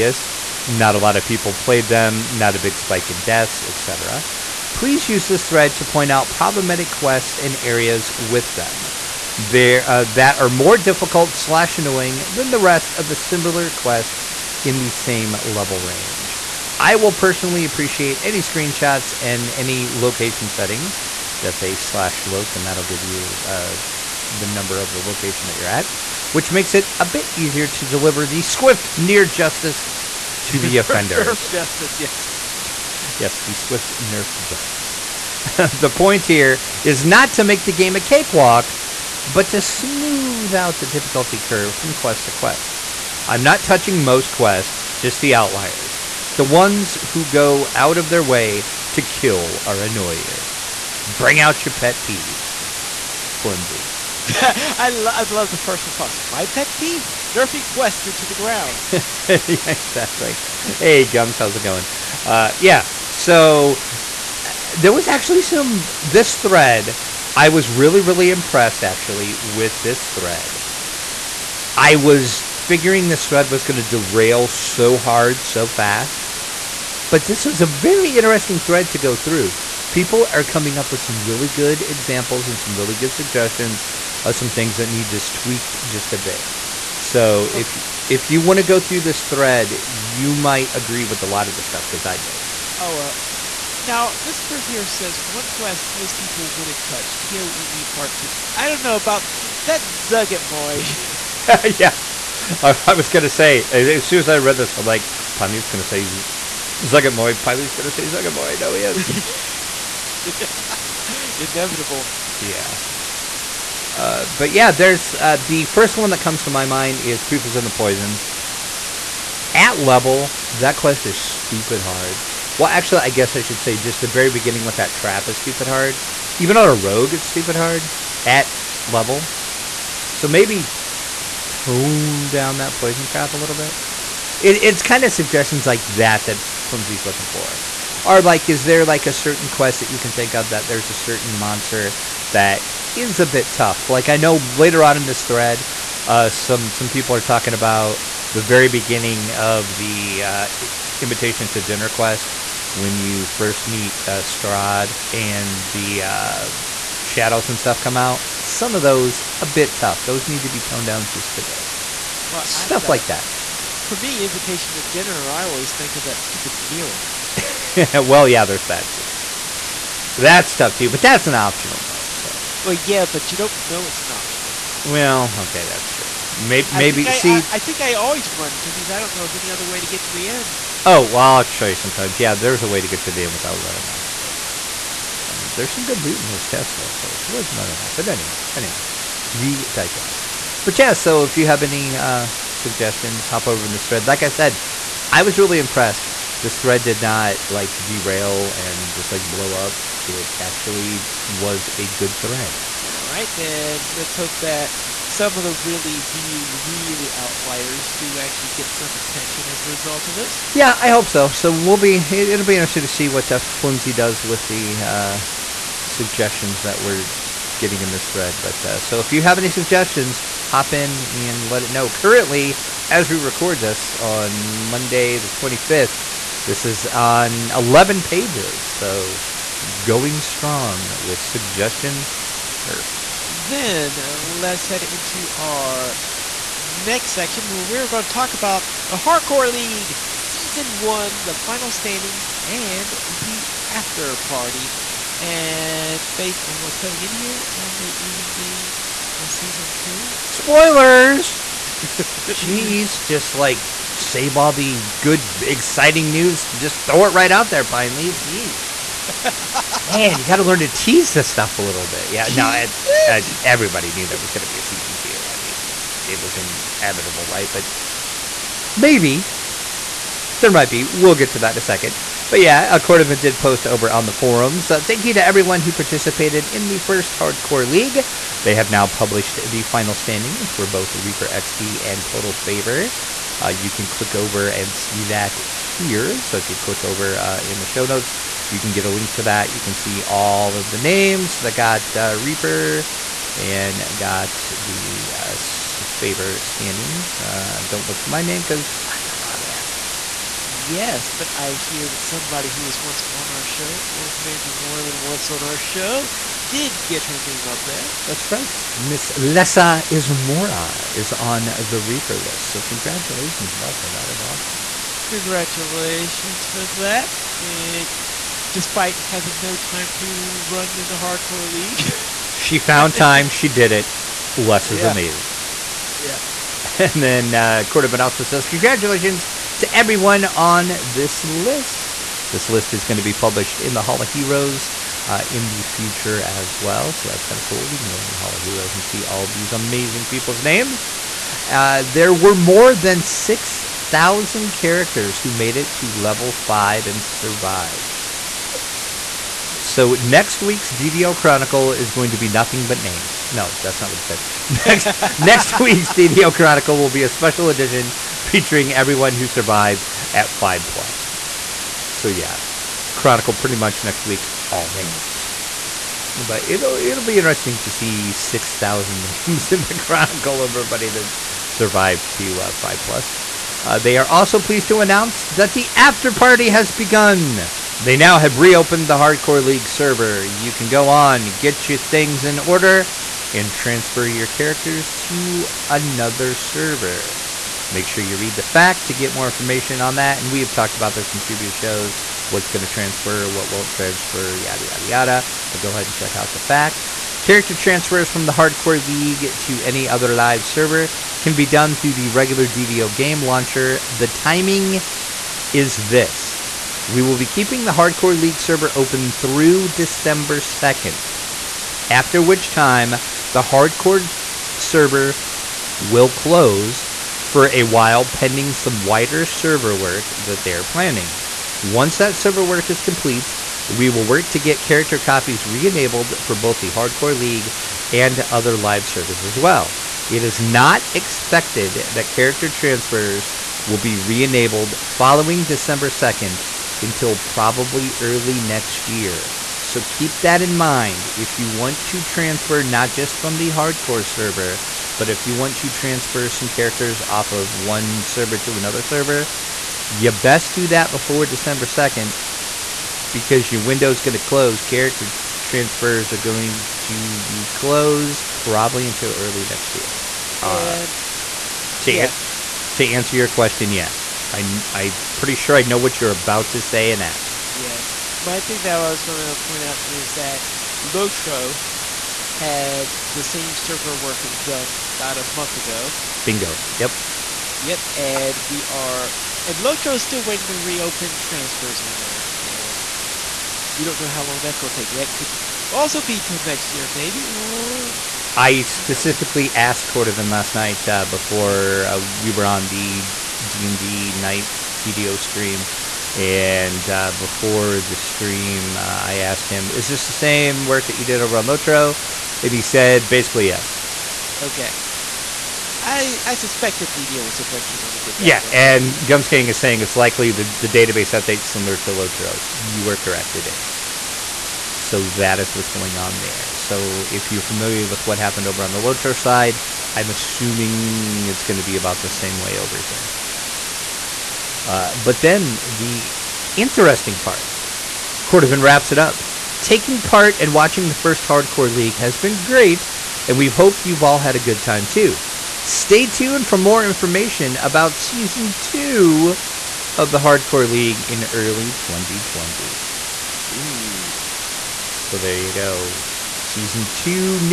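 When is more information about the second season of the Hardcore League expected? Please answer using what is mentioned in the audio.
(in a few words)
early 2020.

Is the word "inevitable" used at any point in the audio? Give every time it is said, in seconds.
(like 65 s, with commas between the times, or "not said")
111 s, 266 s.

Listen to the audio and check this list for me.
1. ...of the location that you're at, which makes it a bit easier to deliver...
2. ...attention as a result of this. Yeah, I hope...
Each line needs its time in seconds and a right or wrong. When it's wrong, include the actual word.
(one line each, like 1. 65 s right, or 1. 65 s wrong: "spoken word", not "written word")
1. 24 s right
2. 208 s right.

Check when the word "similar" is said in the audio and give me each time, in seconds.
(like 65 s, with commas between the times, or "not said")
13 s, 511 s.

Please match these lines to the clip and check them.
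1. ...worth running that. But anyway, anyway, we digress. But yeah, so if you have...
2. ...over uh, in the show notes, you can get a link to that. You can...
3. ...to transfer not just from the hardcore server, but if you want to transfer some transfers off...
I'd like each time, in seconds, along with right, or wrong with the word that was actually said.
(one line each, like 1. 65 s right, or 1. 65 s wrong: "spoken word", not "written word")
1. 187 s right
2. 286 s right
3. 441 s wrong: "characters", not "transfers".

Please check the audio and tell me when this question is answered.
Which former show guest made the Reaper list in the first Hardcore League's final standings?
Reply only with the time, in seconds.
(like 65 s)
309 s.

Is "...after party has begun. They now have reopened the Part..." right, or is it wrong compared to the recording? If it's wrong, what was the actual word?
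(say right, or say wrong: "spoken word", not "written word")
wrong: "Hardcore", not "Part".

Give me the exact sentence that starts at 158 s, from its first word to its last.
Some of those a bit tough.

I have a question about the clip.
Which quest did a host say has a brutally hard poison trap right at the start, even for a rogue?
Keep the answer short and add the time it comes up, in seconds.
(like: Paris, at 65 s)
Prepus and the Poison, at 117 s.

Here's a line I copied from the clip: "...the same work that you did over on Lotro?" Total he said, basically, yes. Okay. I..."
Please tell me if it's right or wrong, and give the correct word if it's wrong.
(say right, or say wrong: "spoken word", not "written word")
wrong: "And", not "Total".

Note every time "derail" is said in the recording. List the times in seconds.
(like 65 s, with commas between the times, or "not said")
73 s, 197 s.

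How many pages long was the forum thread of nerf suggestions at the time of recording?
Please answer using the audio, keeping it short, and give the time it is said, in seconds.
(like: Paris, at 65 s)
11, at 227 s.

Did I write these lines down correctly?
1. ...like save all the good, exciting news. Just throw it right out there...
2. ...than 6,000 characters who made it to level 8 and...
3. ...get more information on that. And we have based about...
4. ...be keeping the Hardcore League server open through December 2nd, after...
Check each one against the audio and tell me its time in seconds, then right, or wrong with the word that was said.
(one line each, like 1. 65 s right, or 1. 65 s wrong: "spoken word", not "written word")
1. 253 s right
2. 342 s wrong: "5", not "8"
3. 388 s wrong: "talked", not "based"
4. 407 s right.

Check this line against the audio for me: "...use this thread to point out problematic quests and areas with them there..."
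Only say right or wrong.
right.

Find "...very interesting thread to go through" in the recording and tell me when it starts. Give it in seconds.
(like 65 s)
77 s.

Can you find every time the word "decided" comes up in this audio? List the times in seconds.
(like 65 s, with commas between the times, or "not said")
not said.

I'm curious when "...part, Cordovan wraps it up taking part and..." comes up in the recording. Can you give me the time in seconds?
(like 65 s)
527 s.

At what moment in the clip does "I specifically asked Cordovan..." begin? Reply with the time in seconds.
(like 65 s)
488 s.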